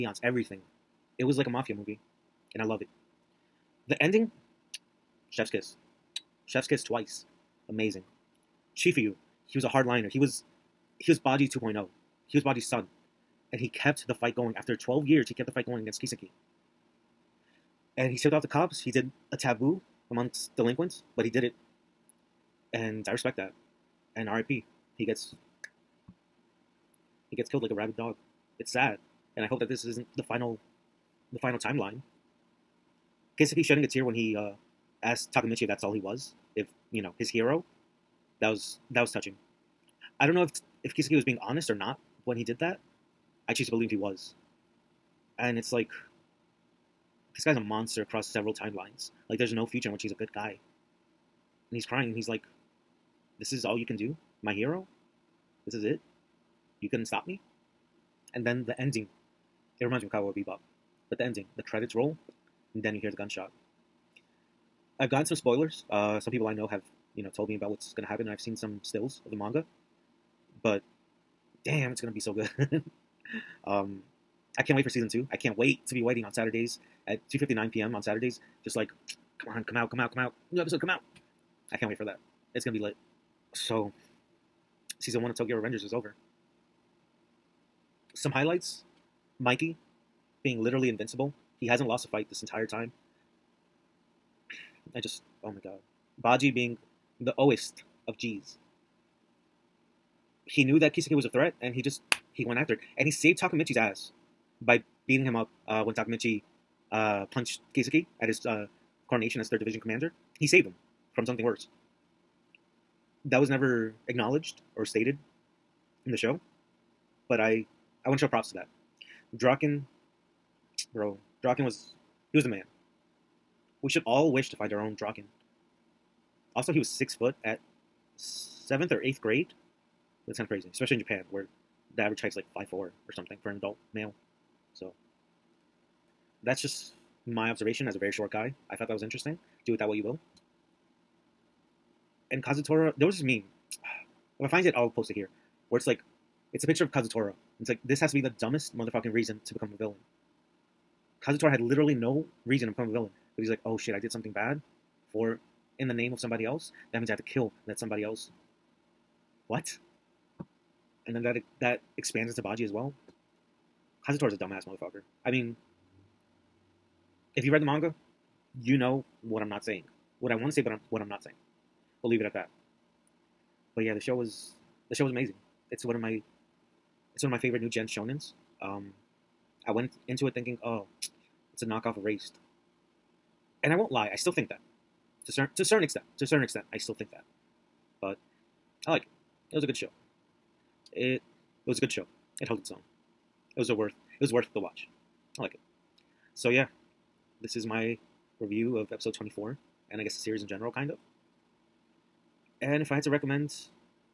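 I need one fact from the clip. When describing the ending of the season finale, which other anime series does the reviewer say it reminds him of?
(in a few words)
Cowboy Bebop.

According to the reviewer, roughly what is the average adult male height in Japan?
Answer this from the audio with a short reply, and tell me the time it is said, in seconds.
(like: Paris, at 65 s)
5'4", at 132 s.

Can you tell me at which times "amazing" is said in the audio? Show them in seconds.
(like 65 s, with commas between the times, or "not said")
7 s, 175 s.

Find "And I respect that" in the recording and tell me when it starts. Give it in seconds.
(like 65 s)
22 s.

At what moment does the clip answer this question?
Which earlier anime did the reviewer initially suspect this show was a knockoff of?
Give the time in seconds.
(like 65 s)
181 s.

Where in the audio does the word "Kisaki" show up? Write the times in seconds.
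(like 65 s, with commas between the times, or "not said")
16 s, 33 s, 40 s, 100 s, 107 s.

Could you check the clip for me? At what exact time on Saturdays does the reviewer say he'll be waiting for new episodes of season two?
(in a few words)
2:59 p.m.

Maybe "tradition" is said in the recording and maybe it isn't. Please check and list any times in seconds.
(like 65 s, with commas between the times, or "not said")
not said.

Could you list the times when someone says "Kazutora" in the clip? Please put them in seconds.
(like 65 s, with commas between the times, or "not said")
142 s, 146 s, 151 s, 164 s.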